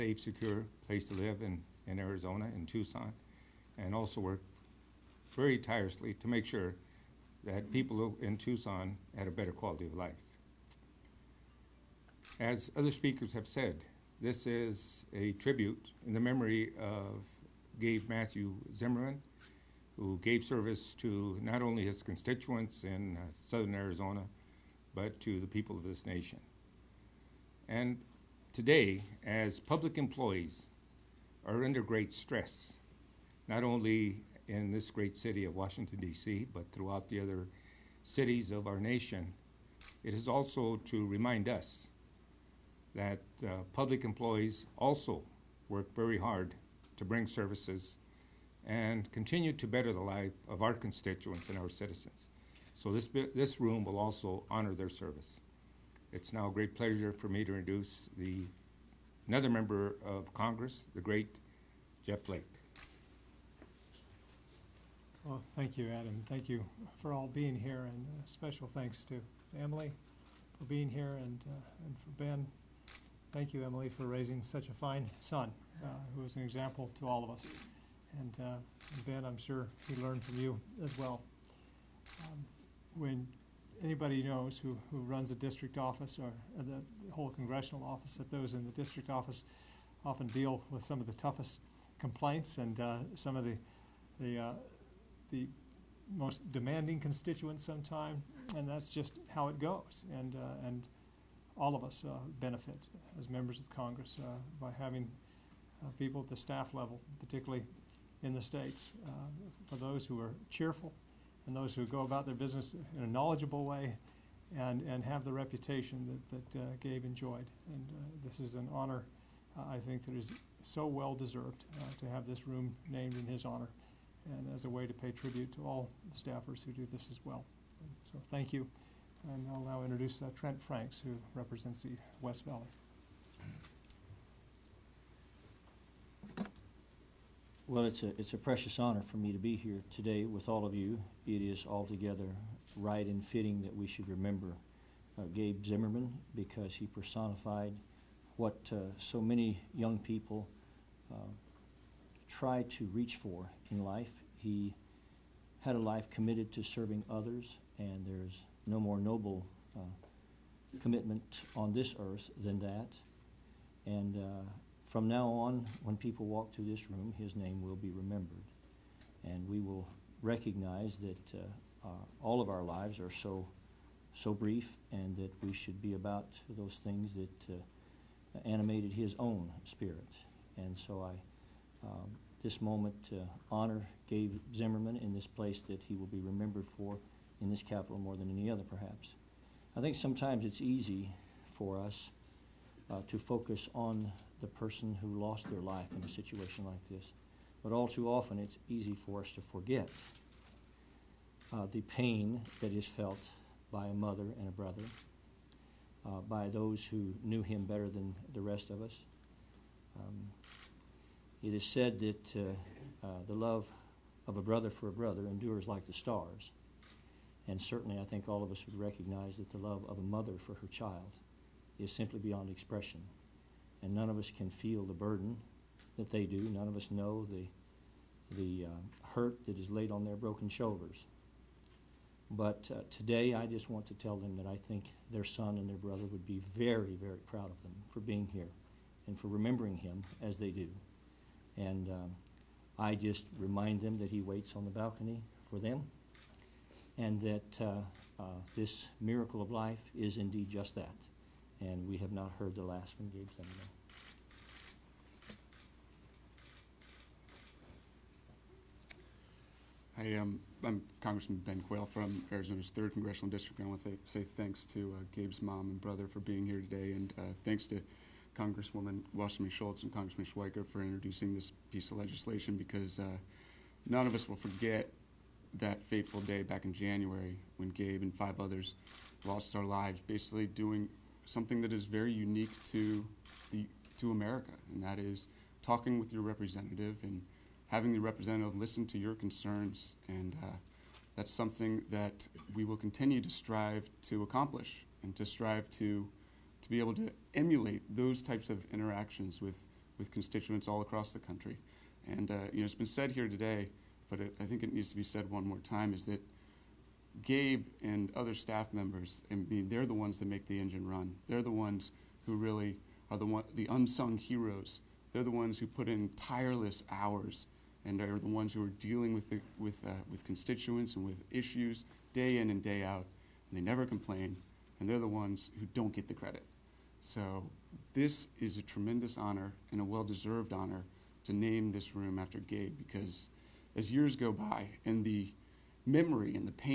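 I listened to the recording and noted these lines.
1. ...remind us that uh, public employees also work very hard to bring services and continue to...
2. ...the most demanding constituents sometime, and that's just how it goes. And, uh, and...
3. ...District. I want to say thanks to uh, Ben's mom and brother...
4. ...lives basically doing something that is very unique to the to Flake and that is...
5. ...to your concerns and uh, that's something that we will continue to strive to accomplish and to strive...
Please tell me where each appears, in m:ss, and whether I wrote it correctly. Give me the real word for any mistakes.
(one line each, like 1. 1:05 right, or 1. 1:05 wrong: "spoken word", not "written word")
1. 0:41 right
2. 1:35 right
3. 4:23 wrong: "Gabe", not "Ben"
4. 4:39 wrong: "America", not "Flake"
5. 4:48 right.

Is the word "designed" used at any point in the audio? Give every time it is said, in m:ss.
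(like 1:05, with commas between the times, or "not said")
not said.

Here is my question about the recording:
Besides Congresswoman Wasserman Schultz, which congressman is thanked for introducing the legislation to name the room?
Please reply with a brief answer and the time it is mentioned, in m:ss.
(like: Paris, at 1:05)
Schweikert, at 4:30.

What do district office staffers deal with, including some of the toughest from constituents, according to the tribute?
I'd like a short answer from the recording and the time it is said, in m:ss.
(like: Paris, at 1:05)
complaints, at 1:32.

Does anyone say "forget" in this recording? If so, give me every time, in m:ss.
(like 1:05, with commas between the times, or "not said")
3:19, 4:34.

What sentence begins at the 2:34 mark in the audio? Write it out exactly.
He had a life committed to serving others, and there's no more noble uh, commitment on this earth than that.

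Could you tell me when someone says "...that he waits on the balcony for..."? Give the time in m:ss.
4:03.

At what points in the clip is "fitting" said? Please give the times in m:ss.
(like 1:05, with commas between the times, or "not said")
2:23.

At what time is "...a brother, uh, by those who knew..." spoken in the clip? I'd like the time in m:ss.
3:24.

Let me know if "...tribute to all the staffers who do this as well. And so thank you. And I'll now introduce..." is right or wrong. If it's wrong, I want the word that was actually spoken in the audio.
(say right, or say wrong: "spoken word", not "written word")
right.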